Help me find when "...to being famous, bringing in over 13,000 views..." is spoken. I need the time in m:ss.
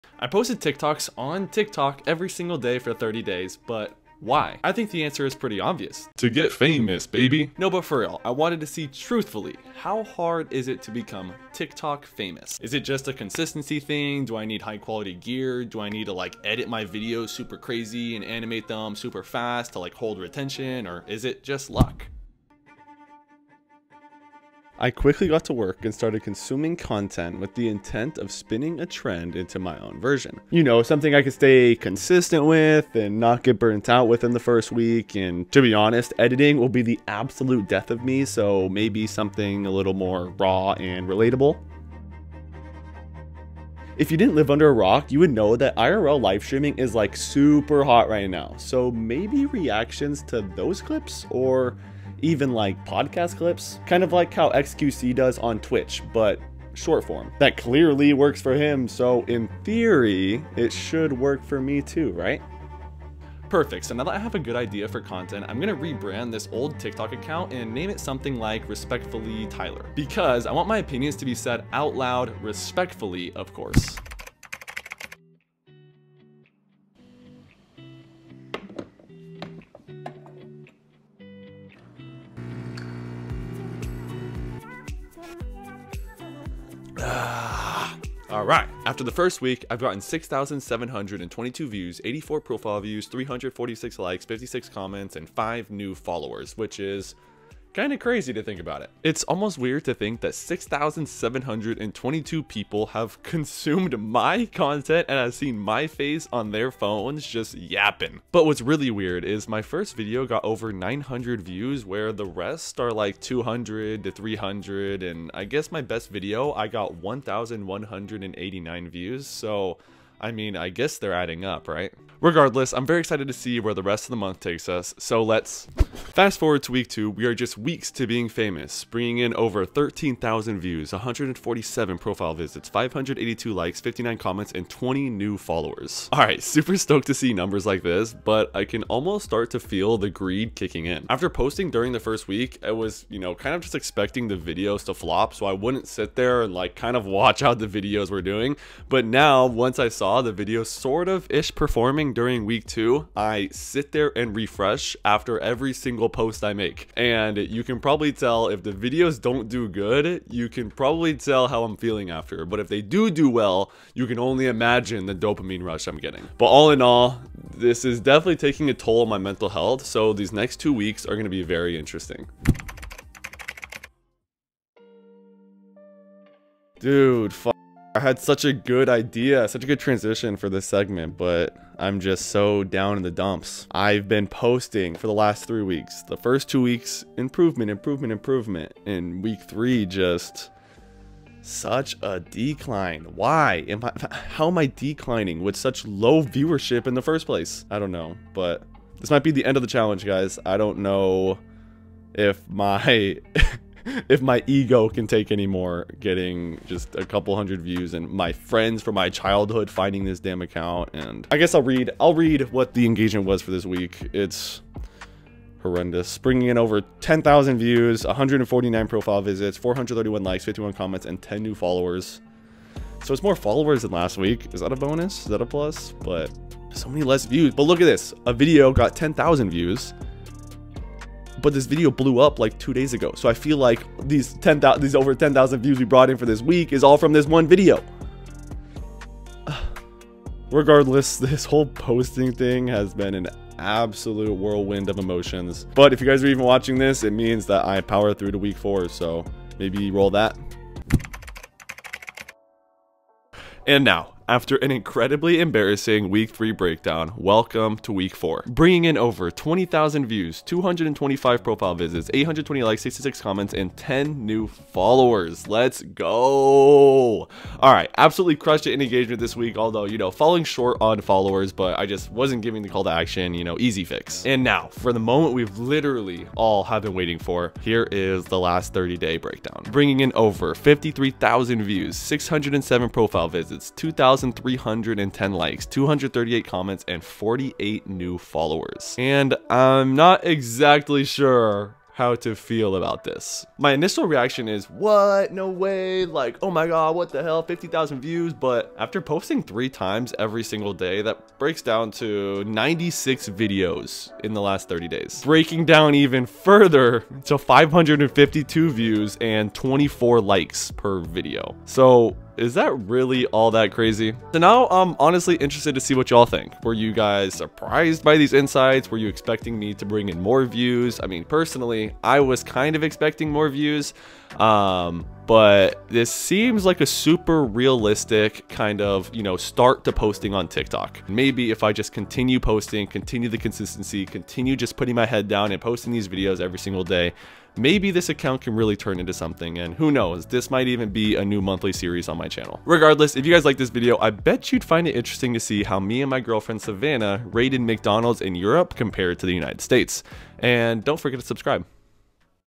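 2:07.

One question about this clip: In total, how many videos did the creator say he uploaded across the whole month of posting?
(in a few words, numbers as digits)
96.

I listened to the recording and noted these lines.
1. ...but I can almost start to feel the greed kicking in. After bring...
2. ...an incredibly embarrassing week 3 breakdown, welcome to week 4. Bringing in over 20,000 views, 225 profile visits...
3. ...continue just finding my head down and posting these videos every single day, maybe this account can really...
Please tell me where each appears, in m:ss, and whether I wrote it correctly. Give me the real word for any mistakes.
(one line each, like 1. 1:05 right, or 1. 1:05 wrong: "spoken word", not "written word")
1. 2:18 wrong: "posting", not "bring"
2. 4:14 right
3. 5:34 wrong: "putting", not "finding".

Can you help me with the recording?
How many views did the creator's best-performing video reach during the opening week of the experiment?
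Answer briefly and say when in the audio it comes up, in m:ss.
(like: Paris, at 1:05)
1,189, at 1:56.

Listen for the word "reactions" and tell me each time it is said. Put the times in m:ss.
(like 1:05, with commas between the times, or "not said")
0:49, 4:54.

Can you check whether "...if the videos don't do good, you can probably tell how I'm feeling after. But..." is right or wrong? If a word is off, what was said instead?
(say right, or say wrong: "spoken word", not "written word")
right.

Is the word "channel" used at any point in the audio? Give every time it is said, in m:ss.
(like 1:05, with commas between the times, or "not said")
5:42.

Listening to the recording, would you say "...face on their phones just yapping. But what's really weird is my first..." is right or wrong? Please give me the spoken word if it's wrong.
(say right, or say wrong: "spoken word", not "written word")
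right.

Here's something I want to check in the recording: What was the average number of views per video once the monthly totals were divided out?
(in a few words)
552.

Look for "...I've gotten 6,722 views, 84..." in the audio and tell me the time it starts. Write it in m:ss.
1:29.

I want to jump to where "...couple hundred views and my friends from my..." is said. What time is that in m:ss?
3:27.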